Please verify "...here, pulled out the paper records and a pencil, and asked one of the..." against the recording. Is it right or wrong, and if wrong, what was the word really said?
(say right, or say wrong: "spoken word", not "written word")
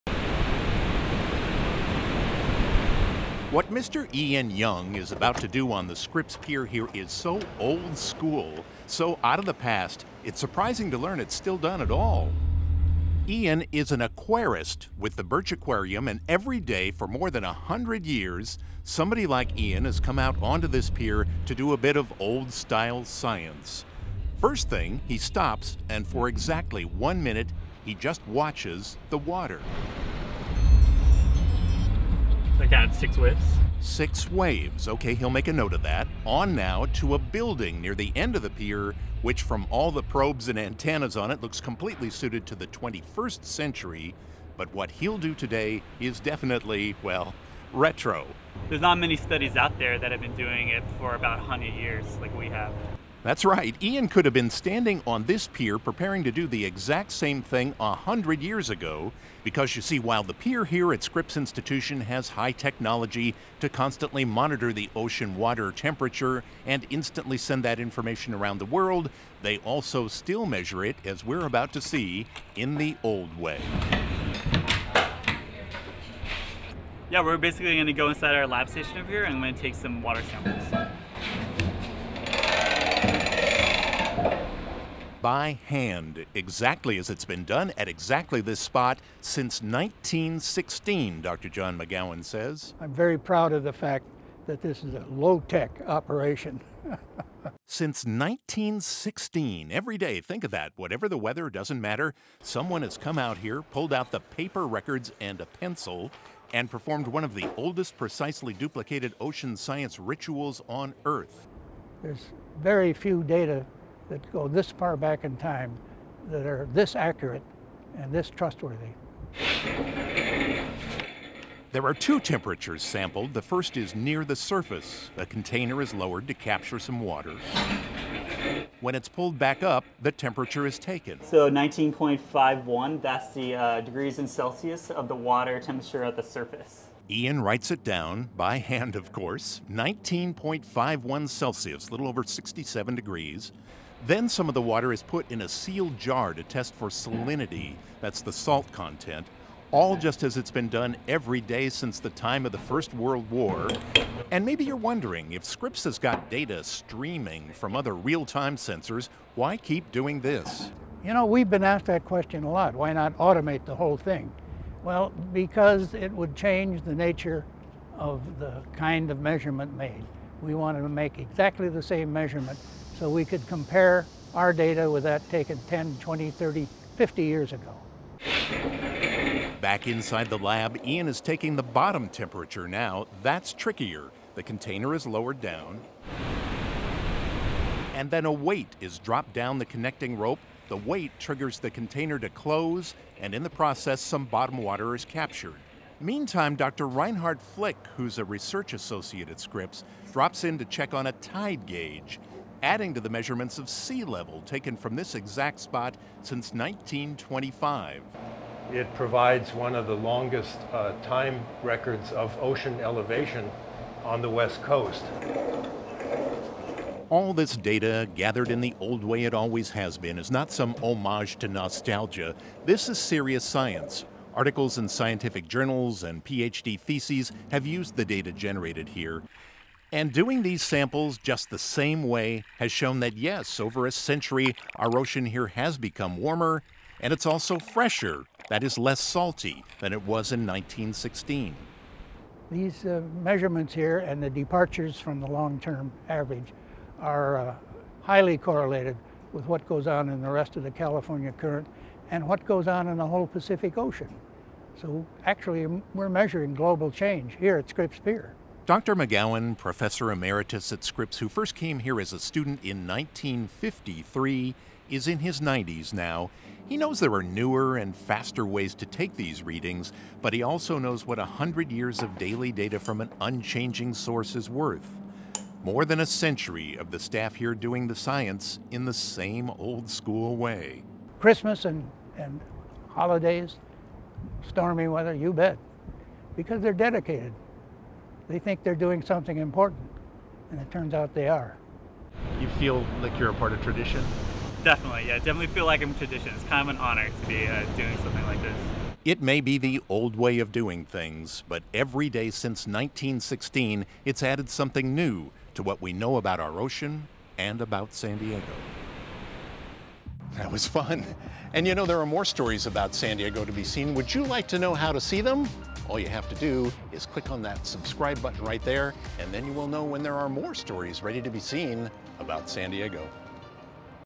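wrong: "performed", not "asked".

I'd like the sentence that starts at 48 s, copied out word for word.
There's not many studies out there that have been doing it for about 100 years like we have.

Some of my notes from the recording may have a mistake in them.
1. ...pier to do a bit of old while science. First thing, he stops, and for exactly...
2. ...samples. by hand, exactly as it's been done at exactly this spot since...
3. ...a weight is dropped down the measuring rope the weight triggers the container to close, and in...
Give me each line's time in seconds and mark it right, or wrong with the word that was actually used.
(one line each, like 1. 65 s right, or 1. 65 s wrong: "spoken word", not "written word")
1. 20 s wrong: "style", not "while"
2. 80 s right
3. 188 s wrong: "connecting", not "measuring".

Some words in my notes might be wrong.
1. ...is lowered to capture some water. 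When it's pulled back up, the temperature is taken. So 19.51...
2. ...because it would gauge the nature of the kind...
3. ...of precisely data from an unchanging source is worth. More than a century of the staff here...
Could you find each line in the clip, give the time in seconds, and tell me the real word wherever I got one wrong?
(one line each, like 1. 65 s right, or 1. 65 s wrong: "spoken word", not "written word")
1. 125 s right
2. 165 s wrong: "change", not "gauge"
3. 272 s wrong: "daily", not "precisely".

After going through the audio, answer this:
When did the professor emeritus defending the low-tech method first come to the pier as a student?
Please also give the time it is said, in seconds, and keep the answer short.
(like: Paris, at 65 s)
1953, at 262 s.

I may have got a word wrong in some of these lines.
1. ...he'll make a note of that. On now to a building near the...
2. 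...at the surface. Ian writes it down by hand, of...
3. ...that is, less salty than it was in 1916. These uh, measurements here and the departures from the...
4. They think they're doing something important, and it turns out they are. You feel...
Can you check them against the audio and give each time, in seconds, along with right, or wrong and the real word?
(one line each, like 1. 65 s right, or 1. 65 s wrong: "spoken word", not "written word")
1. 35 s right
2. 136 s right
3. 238 s right
4. 288 s right.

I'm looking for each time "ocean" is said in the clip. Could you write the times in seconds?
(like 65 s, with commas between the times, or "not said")
64 s, 109 s, 212 s, 234 s, 253 s, 306 s.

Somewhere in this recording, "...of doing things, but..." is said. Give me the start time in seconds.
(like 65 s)
300 s.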